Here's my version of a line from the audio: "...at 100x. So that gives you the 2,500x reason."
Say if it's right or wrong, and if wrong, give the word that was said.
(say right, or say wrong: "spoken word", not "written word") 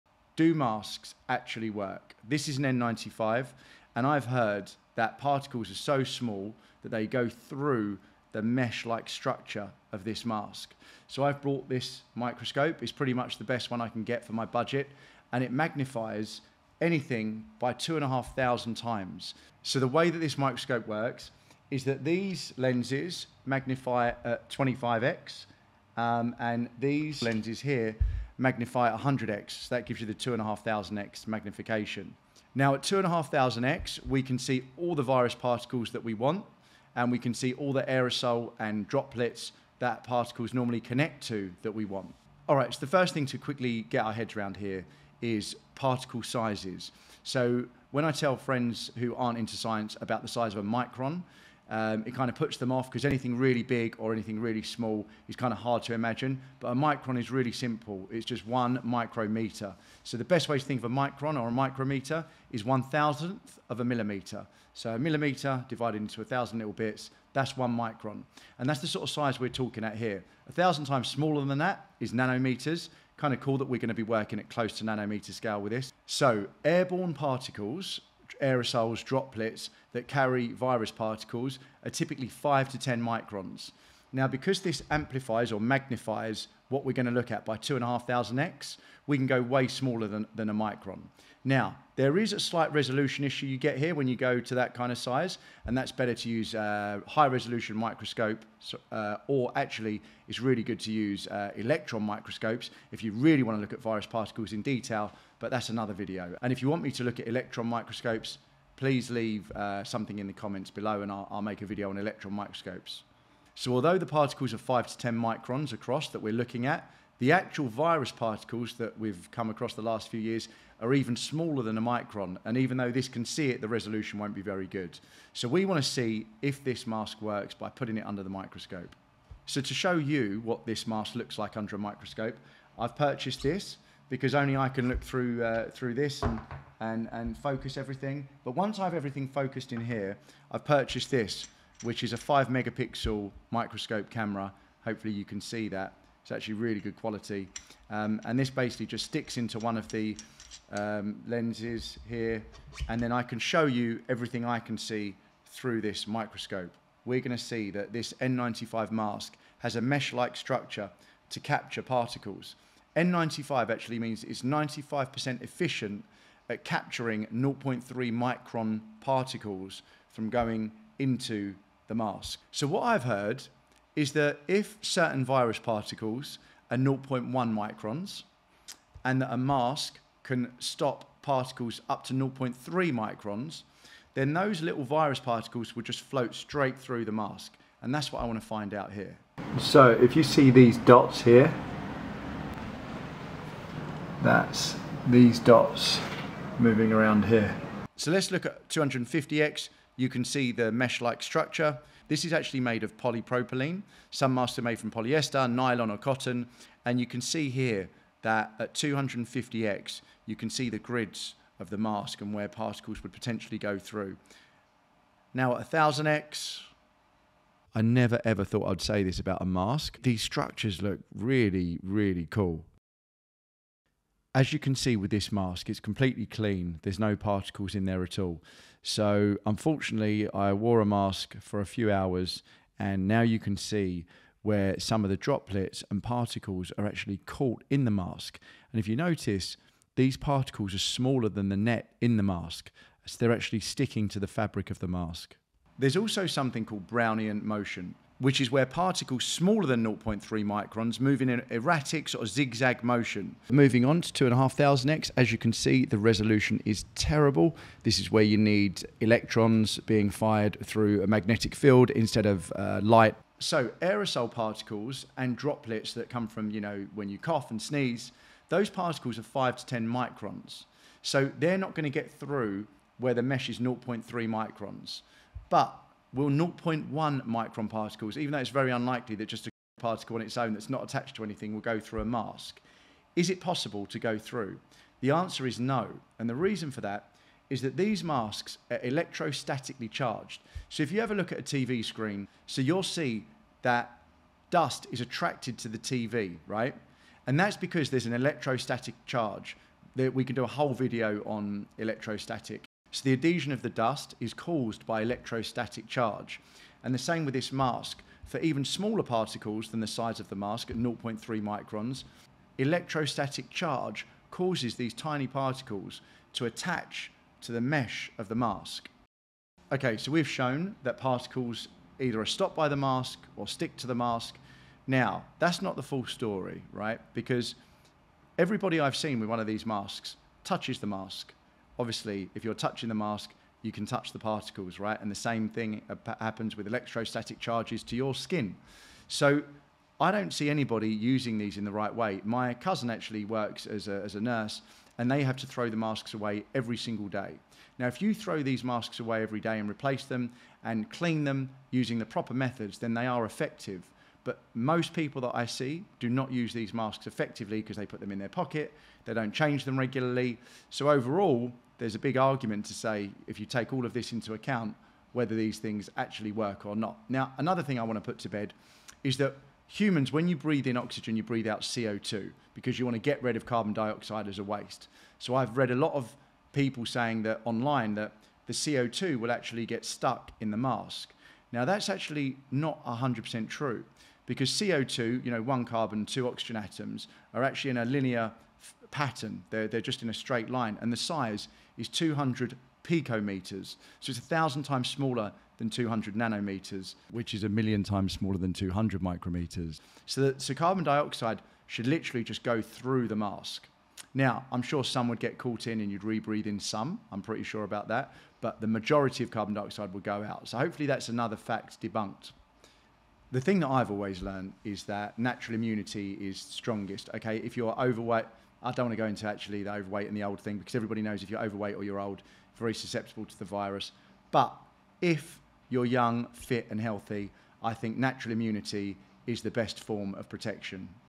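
wrong: "magnification", not "reason".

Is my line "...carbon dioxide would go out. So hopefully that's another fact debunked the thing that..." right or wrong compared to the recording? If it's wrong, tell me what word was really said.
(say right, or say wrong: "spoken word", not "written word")
right.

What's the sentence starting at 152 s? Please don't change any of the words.
And then I can show you everything I can see through this microscope.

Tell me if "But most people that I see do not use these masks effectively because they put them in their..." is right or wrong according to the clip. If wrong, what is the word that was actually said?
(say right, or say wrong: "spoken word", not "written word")
right.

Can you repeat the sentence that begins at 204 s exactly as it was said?
Some masks are made from polyester, nylon or cotton.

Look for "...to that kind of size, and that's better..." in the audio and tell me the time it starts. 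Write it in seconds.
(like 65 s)
94 s.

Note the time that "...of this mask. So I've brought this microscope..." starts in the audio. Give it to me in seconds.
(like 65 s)
9 s.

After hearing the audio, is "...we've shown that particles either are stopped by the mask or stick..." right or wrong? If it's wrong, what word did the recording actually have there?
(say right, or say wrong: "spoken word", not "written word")
right.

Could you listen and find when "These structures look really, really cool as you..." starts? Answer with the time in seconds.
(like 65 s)
220 s.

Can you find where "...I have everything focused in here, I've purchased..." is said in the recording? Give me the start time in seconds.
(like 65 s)
138 s.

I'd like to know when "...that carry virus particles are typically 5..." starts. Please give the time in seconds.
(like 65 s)
79 s.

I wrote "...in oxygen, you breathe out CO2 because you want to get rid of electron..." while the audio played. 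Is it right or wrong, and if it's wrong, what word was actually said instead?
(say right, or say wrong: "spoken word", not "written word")
wrong: "carbon", not "electron".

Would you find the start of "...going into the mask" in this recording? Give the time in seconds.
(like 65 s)
170 s.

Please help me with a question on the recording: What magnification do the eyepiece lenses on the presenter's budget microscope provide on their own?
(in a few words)
25x.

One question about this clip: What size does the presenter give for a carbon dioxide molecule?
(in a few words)
200 picometers.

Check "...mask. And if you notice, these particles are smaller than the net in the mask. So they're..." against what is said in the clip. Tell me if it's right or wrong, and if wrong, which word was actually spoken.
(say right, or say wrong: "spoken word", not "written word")
right.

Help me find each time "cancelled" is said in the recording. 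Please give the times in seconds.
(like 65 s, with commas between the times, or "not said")
not said.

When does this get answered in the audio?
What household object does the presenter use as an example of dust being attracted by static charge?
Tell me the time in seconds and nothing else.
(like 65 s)
291 s.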